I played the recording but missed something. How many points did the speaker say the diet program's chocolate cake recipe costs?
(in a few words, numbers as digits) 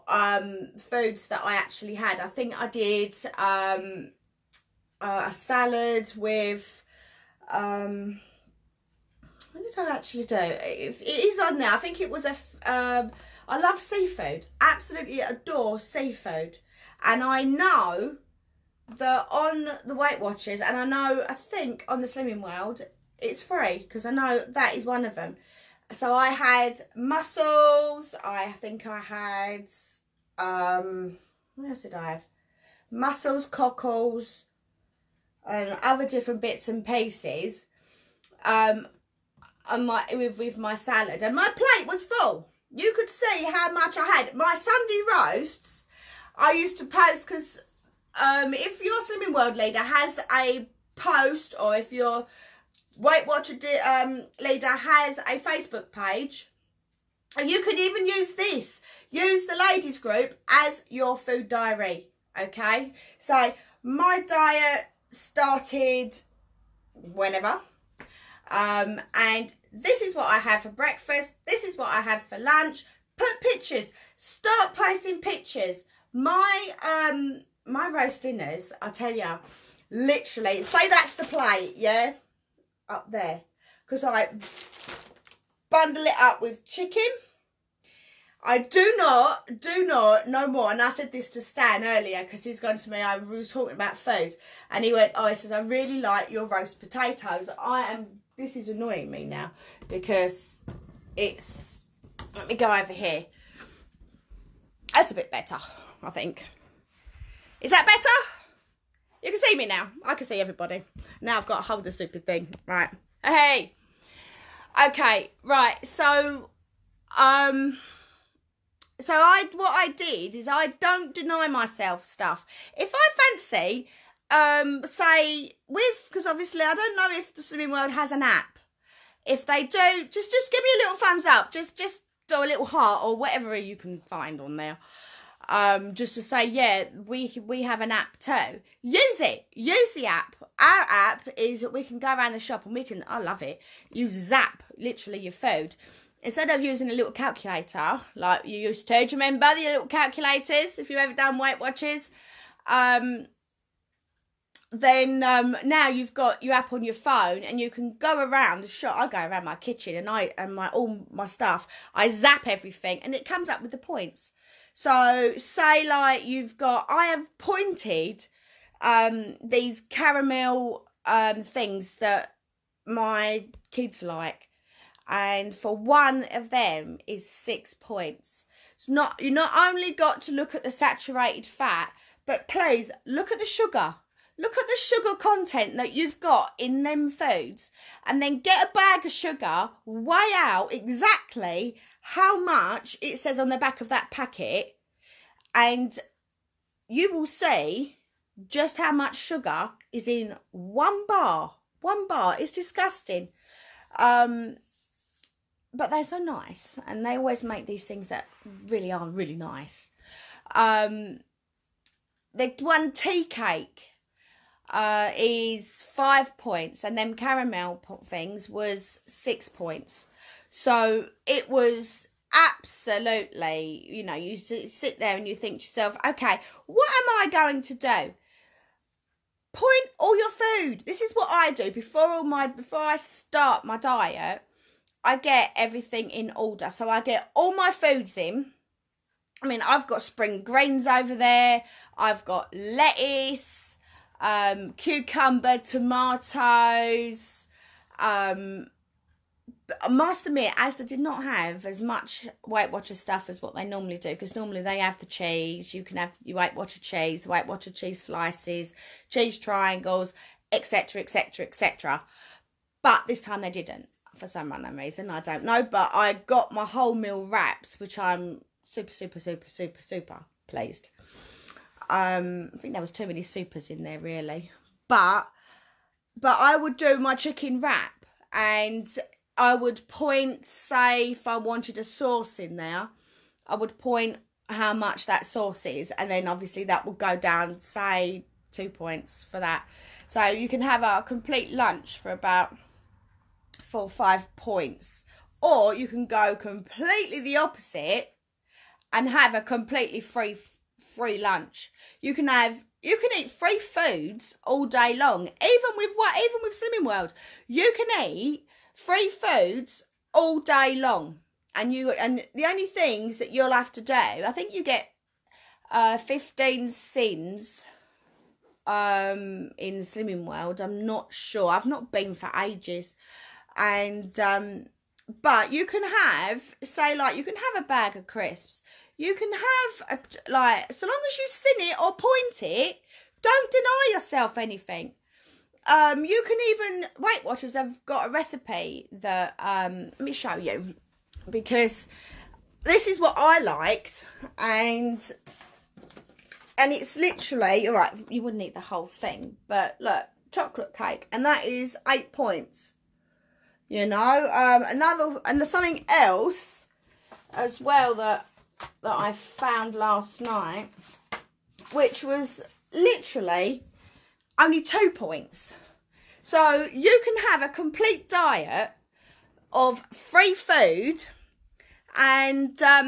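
8.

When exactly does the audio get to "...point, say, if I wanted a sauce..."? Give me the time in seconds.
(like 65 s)
279 s.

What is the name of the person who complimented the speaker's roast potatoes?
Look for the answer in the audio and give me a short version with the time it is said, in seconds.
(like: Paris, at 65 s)
Stan, at 91 s.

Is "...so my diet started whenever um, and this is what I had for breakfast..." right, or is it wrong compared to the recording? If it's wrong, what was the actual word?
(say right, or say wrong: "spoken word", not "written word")
right.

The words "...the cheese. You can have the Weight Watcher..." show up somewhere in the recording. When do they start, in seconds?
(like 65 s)
254 s.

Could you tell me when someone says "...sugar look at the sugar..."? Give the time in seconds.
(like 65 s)
183 s.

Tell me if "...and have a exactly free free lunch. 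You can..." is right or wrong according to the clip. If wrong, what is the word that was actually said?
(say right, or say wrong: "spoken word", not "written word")
wrong: "completely", not "exactly".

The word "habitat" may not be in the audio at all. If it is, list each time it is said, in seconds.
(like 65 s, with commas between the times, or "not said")
not said.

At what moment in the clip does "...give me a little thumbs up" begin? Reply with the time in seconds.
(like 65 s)
130 s.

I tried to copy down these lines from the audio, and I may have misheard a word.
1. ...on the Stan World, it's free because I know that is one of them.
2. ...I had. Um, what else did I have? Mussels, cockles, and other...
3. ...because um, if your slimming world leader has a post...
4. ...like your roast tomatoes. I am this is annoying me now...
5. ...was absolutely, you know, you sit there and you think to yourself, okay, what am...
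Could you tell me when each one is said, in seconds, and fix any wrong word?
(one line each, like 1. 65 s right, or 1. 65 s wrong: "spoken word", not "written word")
1. 21 s wrong: "Slimming", not "Stan"
2. 28 s right
3. 47 s right
4. 95 s wrong: "potatoes", not "tomatoes"
5. 221 s right.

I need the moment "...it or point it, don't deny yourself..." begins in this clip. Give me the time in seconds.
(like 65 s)
331 s.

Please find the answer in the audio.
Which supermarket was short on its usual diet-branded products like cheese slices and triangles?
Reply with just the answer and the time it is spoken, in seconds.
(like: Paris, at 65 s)
Asda, at 250 s.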